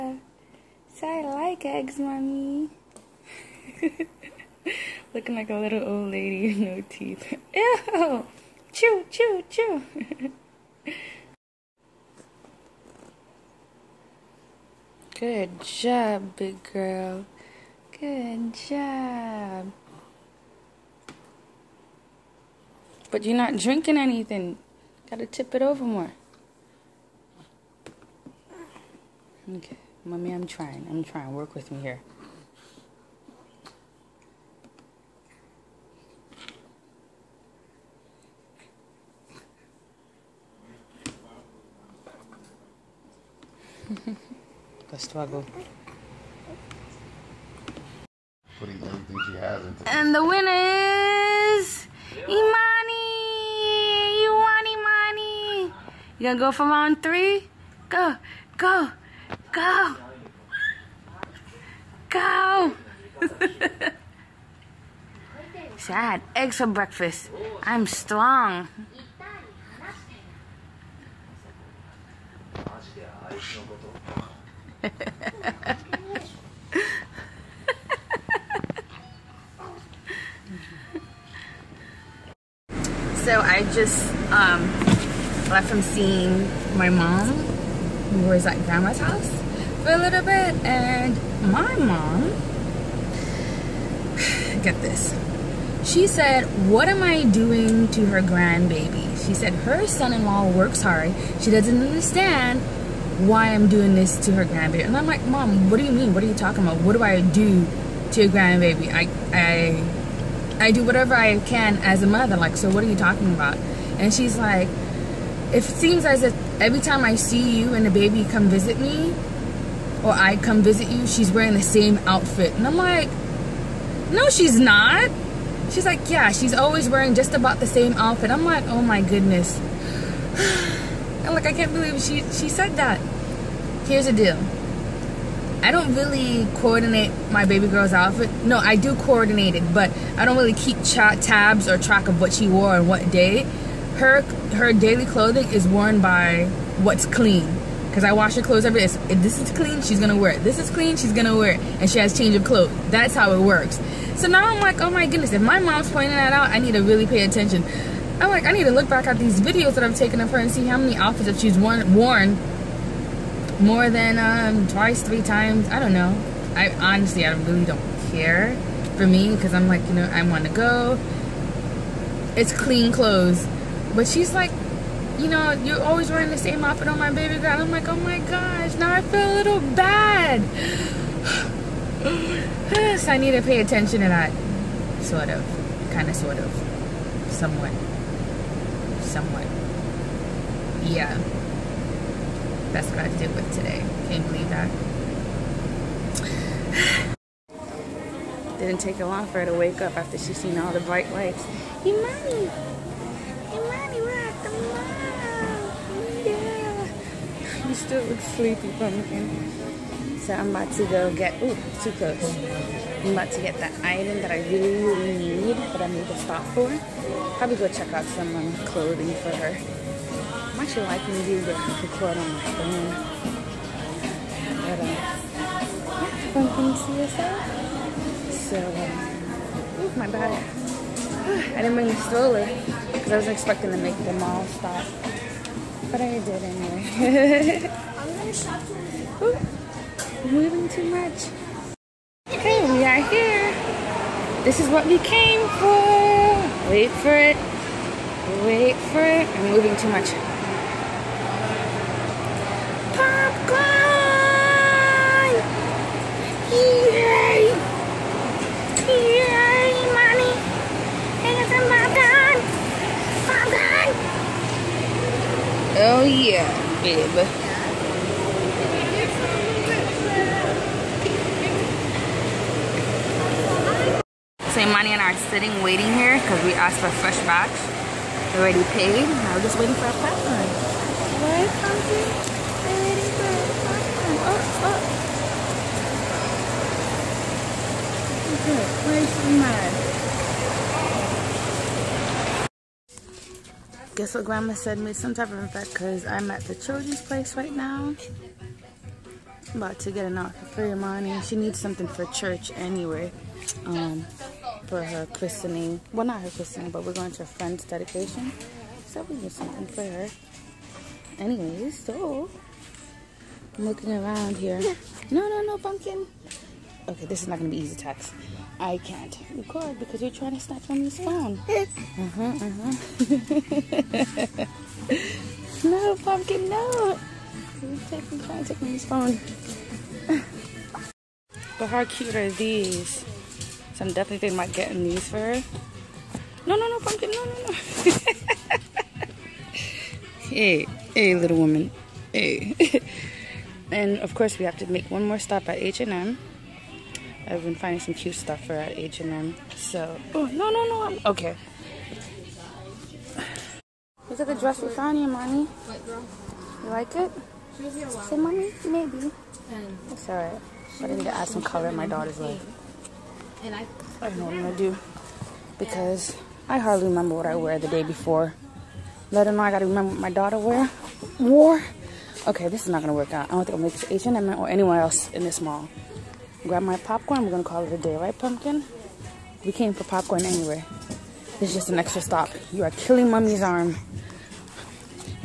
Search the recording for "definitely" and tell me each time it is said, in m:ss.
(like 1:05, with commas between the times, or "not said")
5:33.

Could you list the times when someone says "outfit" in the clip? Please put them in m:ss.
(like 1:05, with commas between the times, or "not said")
2:02, 2:07, 2:17, 2:40, 2:56, 5:00.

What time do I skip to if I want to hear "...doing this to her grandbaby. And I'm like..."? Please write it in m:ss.
1:43.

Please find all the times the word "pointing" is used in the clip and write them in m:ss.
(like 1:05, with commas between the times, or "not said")
2:35.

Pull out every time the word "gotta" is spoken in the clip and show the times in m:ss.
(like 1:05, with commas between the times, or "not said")
0:25, 6:09.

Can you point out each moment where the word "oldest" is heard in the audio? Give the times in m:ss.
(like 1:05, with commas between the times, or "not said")
not said.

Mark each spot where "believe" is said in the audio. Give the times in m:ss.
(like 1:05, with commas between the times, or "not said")
2:11, 3:14.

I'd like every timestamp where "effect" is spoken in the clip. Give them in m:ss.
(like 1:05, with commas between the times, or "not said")
4:55.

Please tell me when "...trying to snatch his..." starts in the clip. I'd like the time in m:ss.
5:20.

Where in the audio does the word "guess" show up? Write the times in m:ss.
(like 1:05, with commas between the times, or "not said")
4:53.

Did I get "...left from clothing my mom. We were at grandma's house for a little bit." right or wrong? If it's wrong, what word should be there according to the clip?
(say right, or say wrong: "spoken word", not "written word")
wrong: "seeing", not "clothing".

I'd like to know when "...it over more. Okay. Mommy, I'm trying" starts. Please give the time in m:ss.
0:25.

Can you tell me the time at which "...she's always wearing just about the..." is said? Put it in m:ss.
2:06.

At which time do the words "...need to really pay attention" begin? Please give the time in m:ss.
2:36.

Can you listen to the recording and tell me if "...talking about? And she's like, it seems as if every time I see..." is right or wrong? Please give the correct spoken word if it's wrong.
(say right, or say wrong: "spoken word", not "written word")
right.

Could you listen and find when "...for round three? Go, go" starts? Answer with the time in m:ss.
0:56.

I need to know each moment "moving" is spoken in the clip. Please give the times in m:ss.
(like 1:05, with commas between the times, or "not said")
4:00, 4:09.